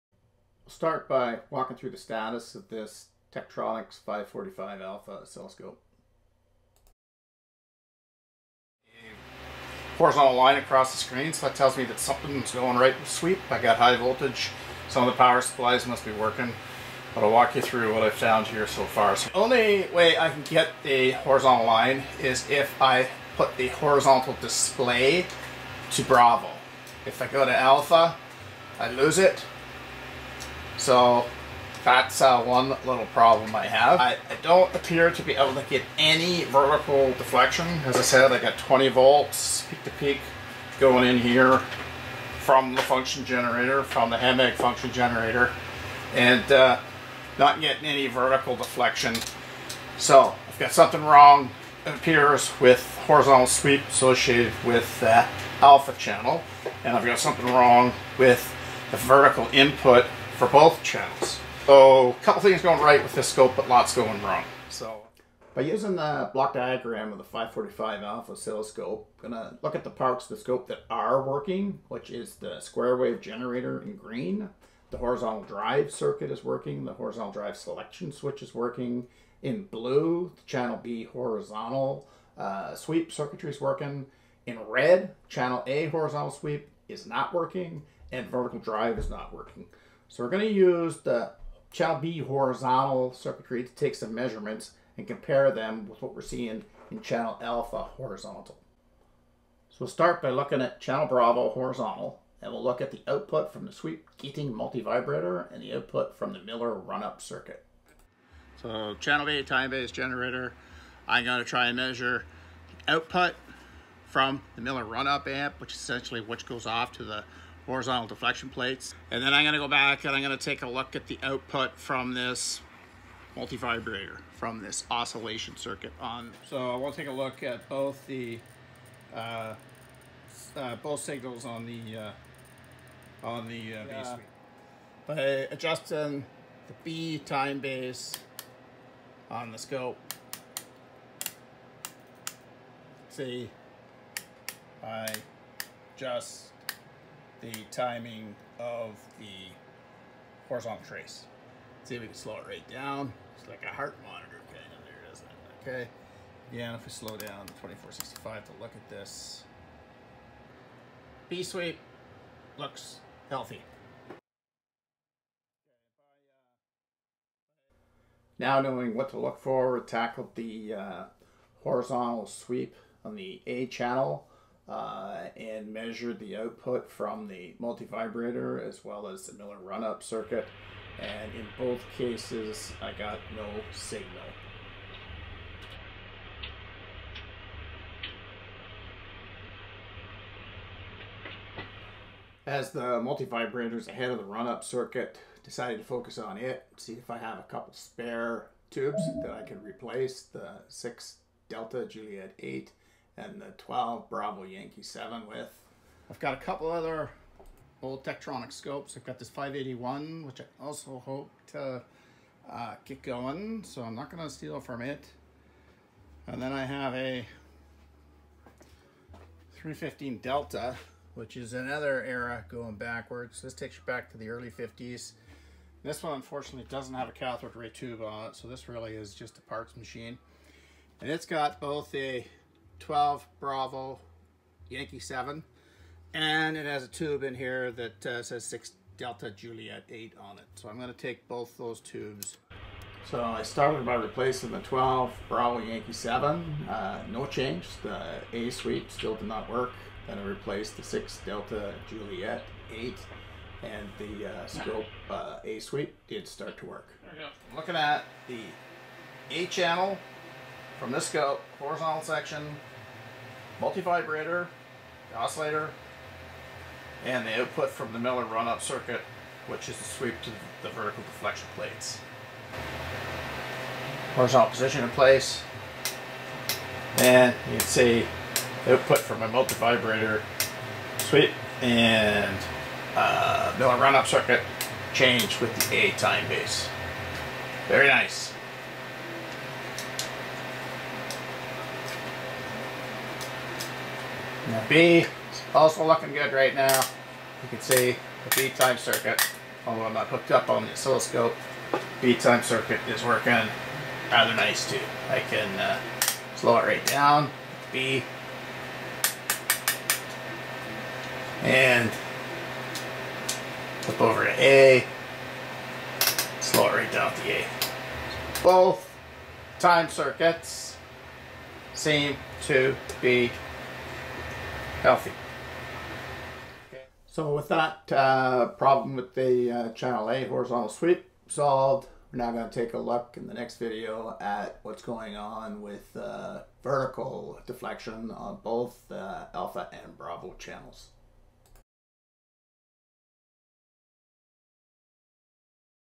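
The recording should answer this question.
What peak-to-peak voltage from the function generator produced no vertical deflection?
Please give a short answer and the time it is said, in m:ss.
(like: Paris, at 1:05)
20 volts, at 0:38.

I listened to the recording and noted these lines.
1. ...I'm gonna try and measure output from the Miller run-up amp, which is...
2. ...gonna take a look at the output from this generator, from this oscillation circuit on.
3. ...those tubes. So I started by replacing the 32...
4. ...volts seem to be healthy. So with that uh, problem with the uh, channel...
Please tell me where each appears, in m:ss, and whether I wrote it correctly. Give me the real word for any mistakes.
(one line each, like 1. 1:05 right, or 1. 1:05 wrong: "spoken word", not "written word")
1. 1:51 right
2. 2:00 wrong: "multivibrator", not "generator"
3. 4:01 wrong: "12", not "32"
4. 5:19 wrong: "circuits", not "volts".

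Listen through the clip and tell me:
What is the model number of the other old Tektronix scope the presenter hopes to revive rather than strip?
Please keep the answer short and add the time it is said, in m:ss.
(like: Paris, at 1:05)
581, at 3:29.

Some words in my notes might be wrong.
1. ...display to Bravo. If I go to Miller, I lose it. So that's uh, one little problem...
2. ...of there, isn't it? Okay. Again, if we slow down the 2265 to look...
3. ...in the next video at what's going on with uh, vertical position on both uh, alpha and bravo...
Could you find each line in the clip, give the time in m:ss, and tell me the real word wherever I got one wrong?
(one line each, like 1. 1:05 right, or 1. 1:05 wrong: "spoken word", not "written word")
1. 0:24 wrong: "Alpha", not "Miller"
2. 2:34 wrong: "2465", not "2265"
3. 5:33 wrong: "deflection", not "position".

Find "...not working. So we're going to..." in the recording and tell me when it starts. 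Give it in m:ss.
1:29.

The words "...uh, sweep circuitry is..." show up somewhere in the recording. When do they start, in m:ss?
1:22.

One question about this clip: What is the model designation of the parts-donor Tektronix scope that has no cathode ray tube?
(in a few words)
315D.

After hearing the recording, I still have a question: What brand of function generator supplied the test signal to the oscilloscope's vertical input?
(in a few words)
Hameg.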